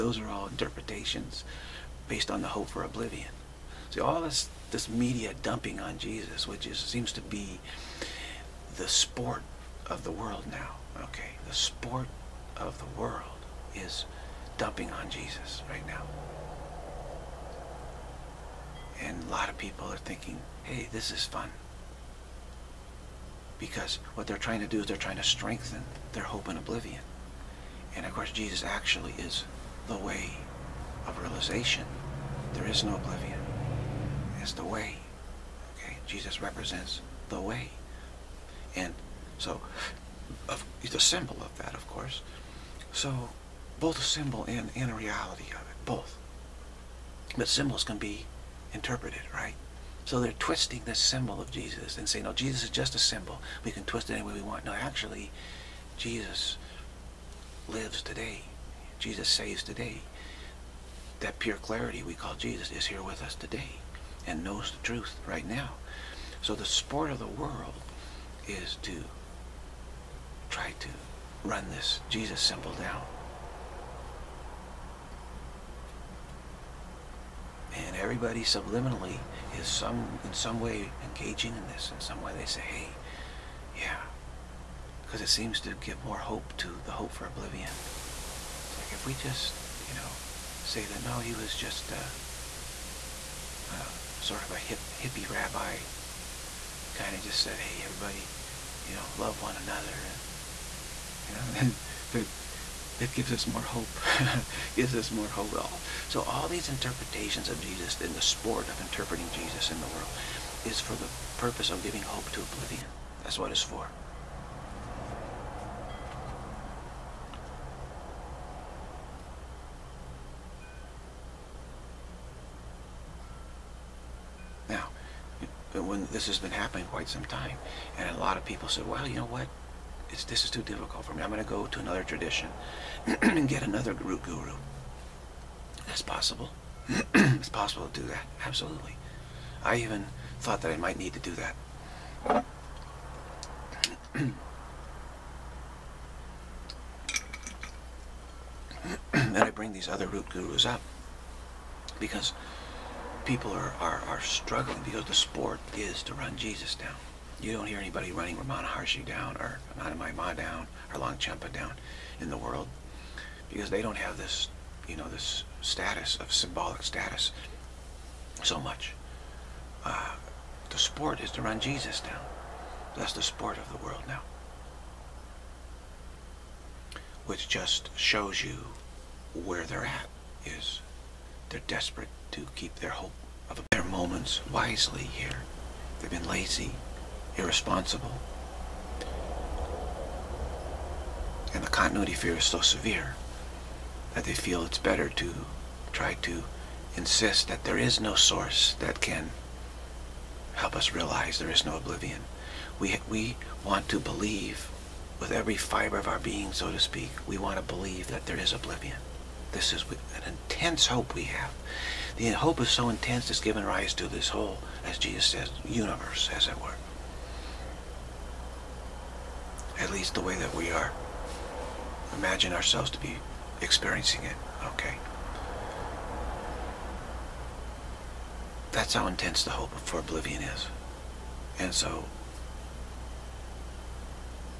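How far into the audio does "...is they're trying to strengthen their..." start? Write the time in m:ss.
0:24.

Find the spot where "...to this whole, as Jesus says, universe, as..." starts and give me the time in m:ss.
3:33.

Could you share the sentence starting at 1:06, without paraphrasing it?
So the sport of the world is to try to run this Jesus symbol down.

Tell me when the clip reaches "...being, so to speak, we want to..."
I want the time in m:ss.
3:26.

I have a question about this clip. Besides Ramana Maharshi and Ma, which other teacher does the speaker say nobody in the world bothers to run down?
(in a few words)
Longchenpa.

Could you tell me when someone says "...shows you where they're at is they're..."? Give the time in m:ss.
2:57.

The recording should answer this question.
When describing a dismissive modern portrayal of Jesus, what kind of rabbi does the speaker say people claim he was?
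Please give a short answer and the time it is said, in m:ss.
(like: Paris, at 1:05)
hippie rabbi, at 1:35.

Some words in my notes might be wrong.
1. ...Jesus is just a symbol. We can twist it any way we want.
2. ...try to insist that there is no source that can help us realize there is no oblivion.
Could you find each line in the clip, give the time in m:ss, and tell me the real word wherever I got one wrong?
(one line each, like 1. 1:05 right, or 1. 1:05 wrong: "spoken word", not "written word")
1. 0:52 right
2. 3:15 right.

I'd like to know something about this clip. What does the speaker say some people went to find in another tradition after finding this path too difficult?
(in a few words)
another root guru.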